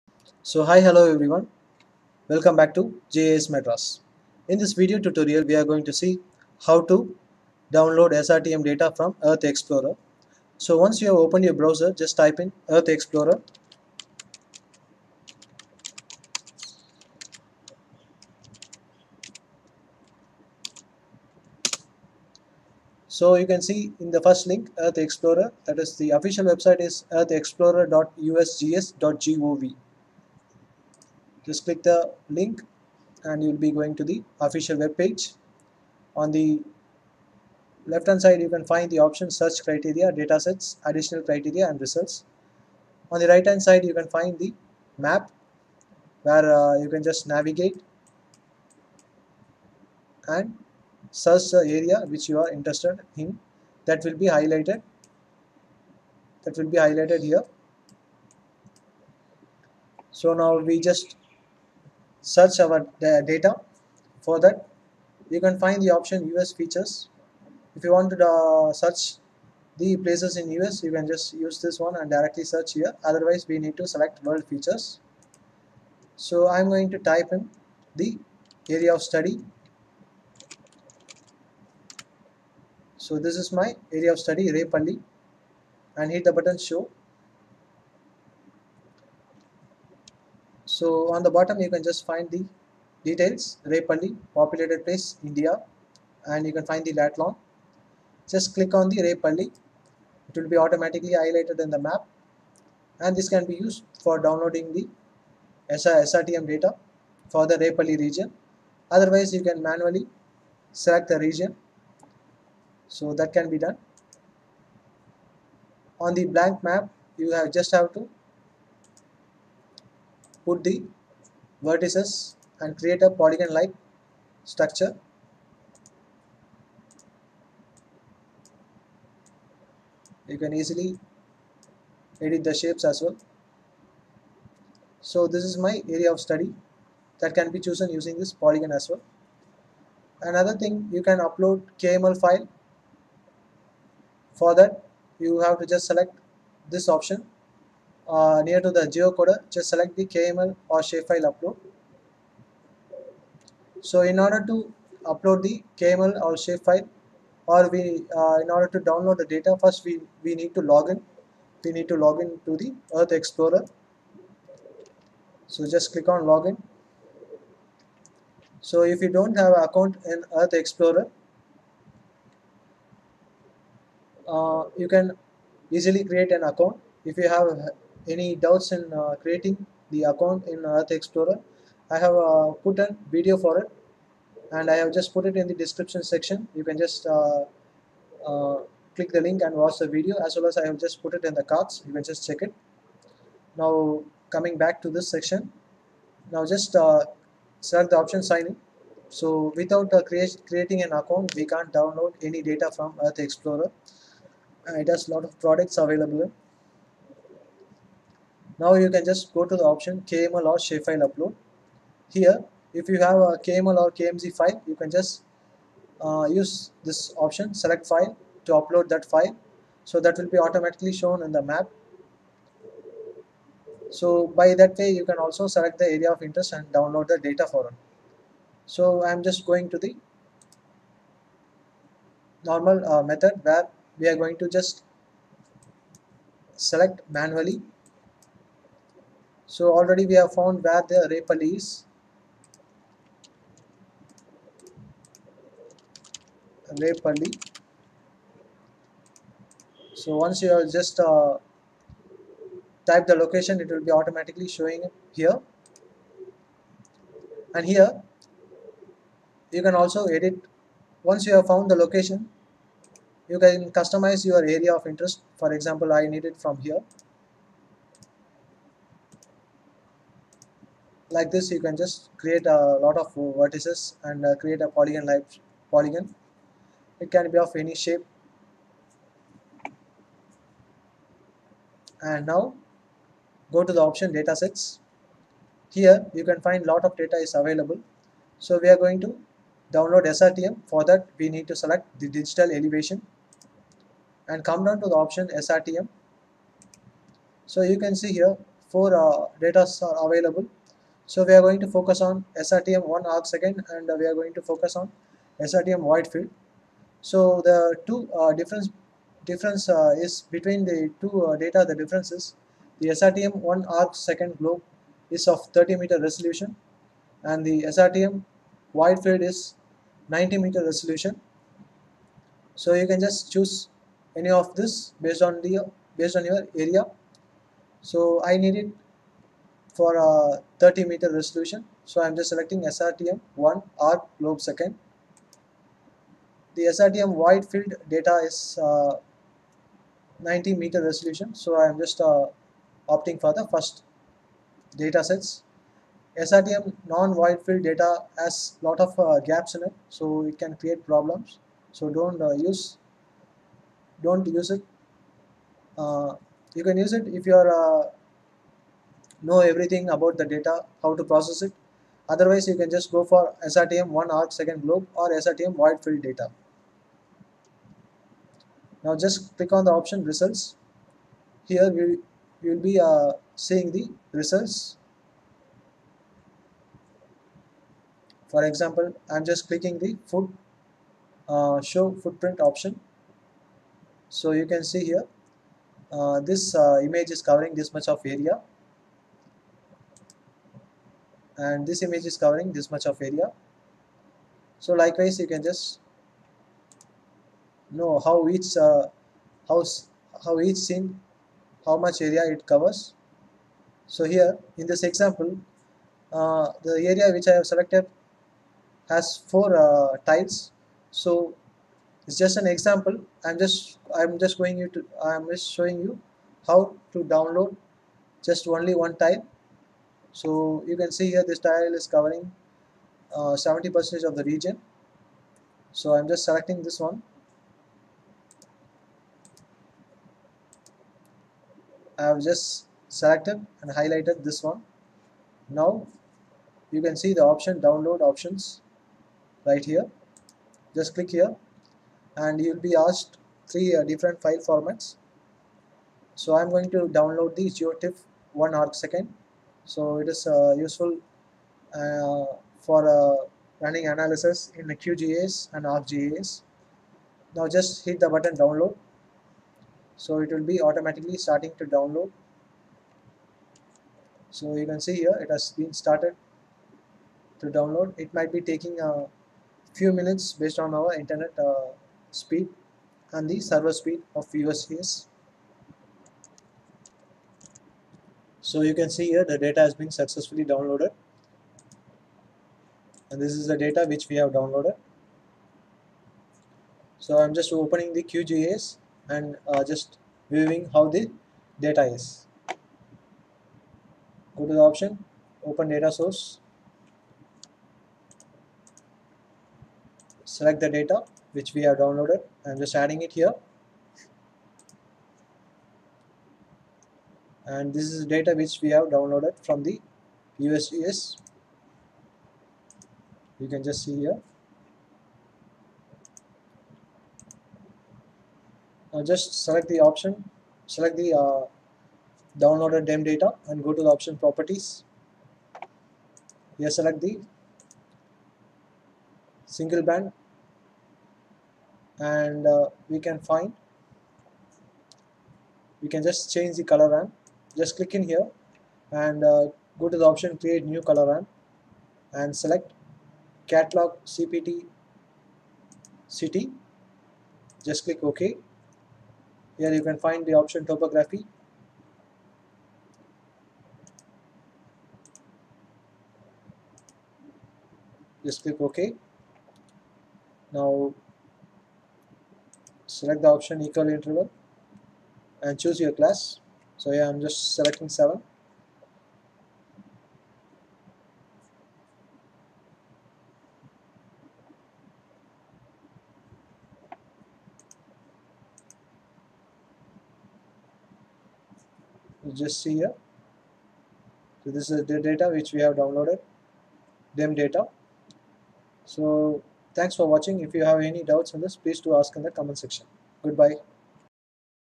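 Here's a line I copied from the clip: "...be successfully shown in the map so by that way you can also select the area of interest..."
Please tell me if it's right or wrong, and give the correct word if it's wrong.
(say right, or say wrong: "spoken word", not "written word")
wrong: "automatically", not "successfully".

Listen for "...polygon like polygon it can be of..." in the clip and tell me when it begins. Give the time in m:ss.
4:34.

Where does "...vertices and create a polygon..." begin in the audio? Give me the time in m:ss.
2:01.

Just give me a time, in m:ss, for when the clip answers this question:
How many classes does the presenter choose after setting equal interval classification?
9:27.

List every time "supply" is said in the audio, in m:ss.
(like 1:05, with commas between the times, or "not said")
not said.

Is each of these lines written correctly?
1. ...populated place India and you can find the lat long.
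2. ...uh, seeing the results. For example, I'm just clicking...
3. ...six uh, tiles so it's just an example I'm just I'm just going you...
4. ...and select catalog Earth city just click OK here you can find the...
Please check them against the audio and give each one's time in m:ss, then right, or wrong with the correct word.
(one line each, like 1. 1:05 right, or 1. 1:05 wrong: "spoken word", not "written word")
1. 1:34 right
2. 6:12 right
3. 6:49 wrong: "four", not "six"
4. 9:02 wrong: "CPT", not "Earth".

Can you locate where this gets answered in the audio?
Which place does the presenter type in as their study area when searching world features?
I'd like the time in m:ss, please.
1:24.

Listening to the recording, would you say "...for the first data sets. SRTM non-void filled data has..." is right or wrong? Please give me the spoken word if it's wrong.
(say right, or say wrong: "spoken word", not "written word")
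right.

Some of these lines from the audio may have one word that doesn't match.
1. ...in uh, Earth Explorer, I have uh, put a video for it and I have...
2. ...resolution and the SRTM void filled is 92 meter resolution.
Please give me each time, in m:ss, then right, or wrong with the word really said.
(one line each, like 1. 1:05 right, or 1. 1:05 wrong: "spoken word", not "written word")
1. 3:00 right
2. 5:16 wrong: "90", not "92".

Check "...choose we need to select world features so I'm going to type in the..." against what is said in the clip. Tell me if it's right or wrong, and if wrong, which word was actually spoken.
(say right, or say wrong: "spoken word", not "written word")
wrong: "otherwise", not "choose".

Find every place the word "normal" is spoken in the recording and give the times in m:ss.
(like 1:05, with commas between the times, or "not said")
3:52.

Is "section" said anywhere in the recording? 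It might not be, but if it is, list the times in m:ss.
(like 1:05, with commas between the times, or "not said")
3:06, 3:15, 9:52.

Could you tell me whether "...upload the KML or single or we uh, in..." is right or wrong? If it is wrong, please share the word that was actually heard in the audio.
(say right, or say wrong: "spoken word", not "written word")
wrong: "shapefile", not "single".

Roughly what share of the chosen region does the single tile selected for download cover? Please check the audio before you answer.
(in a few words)
70%.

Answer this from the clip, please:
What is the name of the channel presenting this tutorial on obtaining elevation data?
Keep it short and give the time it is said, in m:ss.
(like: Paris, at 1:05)
GIS Madras, at 0:03.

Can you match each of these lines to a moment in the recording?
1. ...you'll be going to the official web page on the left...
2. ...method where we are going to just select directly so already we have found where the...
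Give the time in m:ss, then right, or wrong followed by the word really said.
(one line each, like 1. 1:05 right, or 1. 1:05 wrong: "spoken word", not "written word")
1. 0:33 right
2. 3:53 wrong: "manually", not "directly".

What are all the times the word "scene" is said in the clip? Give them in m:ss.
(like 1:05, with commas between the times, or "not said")
6:40.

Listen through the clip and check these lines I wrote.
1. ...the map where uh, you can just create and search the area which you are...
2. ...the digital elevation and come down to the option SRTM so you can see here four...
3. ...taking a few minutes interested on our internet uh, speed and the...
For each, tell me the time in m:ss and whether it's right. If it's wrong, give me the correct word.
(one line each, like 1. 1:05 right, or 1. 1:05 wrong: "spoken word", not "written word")
1. 0:44 wrong: "navigate", not "create"
2. 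4:51 right
3. 7:48 wrong: "based", not "interested".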